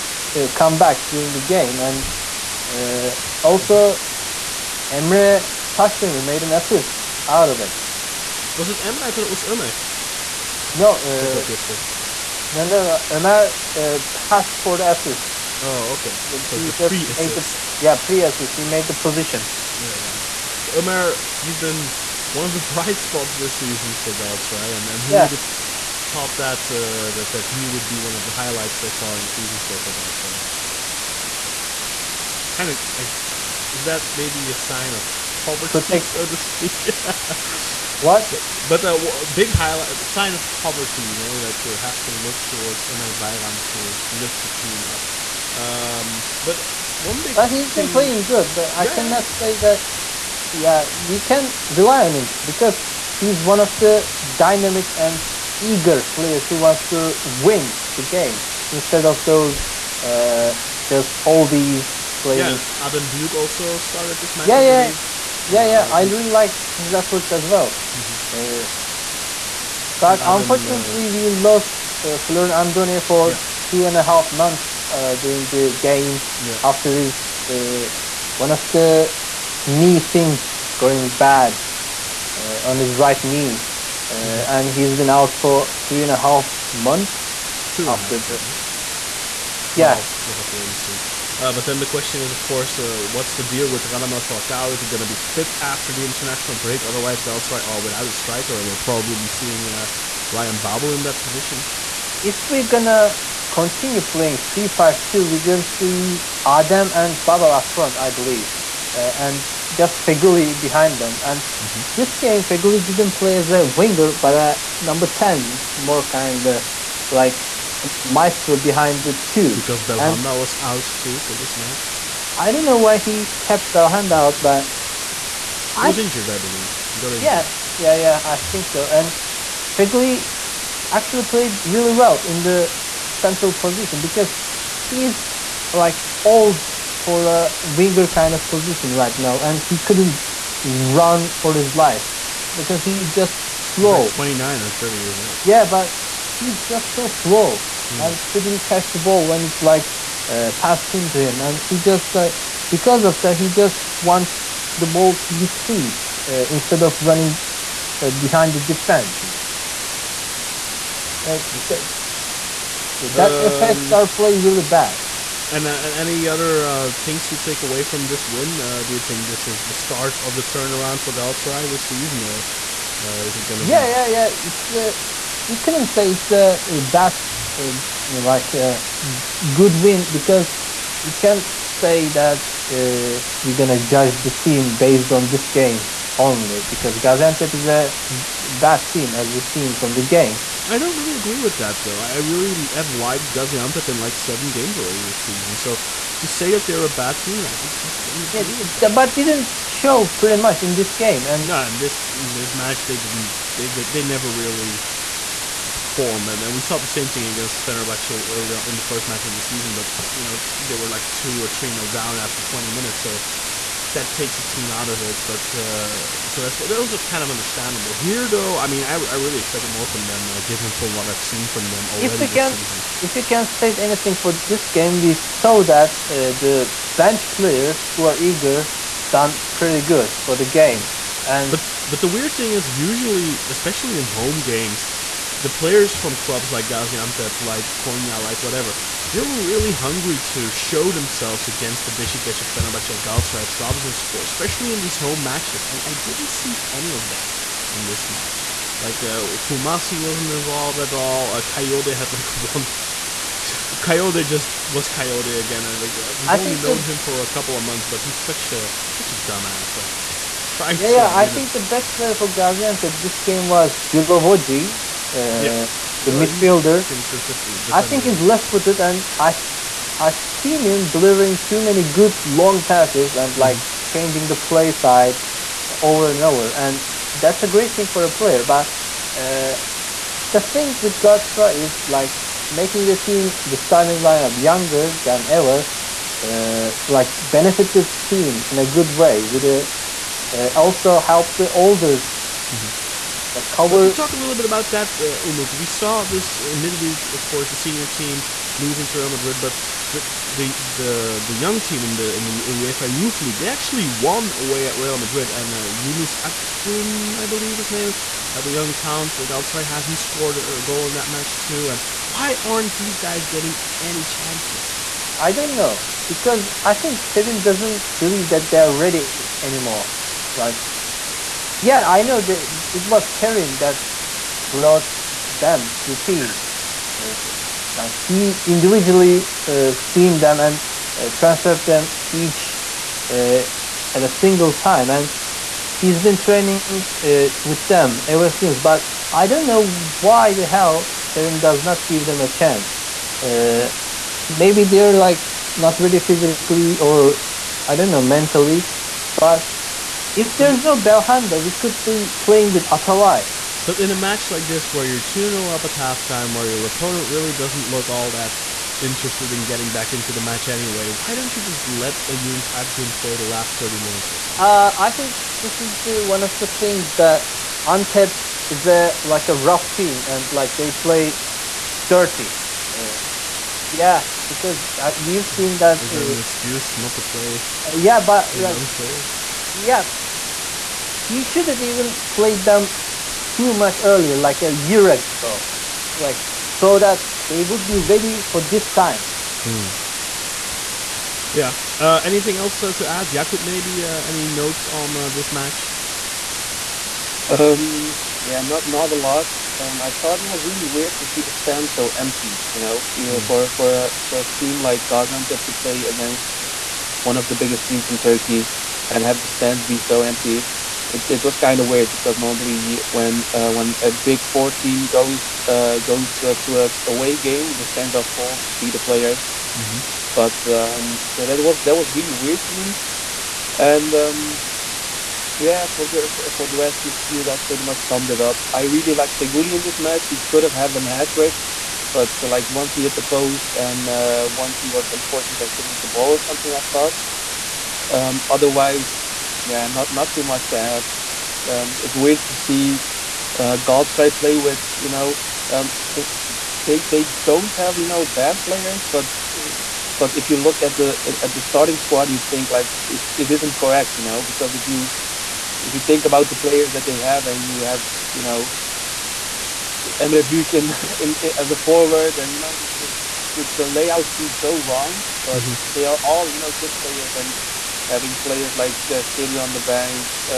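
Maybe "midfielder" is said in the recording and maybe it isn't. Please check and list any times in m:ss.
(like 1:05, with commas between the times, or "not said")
4:26.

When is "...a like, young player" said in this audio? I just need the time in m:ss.
6:18.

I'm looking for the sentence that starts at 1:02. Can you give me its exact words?
Yeah, Adem Büyük also started this match.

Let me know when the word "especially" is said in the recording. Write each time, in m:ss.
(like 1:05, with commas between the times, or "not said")
3:53, 4:04.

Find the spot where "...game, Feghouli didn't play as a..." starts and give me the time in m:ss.
1:52.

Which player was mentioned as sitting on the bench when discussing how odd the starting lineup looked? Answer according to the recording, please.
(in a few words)
Seri.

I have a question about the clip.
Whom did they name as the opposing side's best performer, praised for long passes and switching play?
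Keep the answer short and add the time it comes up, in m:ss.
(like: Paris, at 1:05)
Jilovoji, at 4:23.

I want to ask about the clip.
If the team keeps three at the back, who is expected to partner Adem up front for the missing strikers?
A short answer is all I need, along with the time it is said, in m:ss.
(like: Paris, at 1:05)
Ryan Babel, at 1:40.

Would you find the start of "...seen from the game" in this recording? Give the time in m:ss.
3:09.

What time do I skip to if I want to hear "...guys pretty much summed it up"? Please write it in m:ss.
7:07.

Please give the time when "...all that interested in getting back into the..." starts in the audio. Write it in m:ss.
5:57.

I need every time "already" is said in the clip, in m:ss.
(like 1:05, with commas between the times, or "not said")
3:14, 3:41.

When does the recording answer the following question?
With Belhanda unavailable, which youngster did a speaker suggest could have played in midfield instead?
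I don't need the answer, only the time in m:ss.
5:52.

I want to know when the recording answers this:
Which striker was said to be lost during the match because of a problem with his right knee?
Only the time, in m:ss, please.
1:12.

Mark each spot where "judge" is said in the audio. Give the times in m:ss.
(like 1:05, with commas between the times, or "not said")
3:03.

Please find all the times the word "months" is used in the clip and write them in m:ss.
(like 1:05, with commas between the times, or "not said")
1:14, 1:26, 4:17.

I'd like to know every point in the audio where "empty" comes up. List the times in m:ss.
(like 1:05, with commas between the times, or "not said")
6:41, 6:50.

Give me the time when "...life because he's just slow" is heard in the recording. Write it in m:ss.
2:21.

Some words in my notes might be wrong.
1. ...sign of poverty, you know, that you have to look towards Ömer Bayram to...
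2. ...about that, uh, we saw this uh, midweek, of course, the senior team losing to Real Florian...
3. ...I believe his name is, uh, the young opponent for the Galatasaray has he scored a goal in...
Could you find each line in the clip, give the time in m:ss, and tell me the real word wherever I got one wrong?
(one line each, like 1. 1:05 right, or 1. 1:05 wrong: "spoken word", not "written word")
1. 0:40 right
2. 4:54 wrong: "Madrid", not "Florian"
3. 5:07 wrong: "talent", not "opponent".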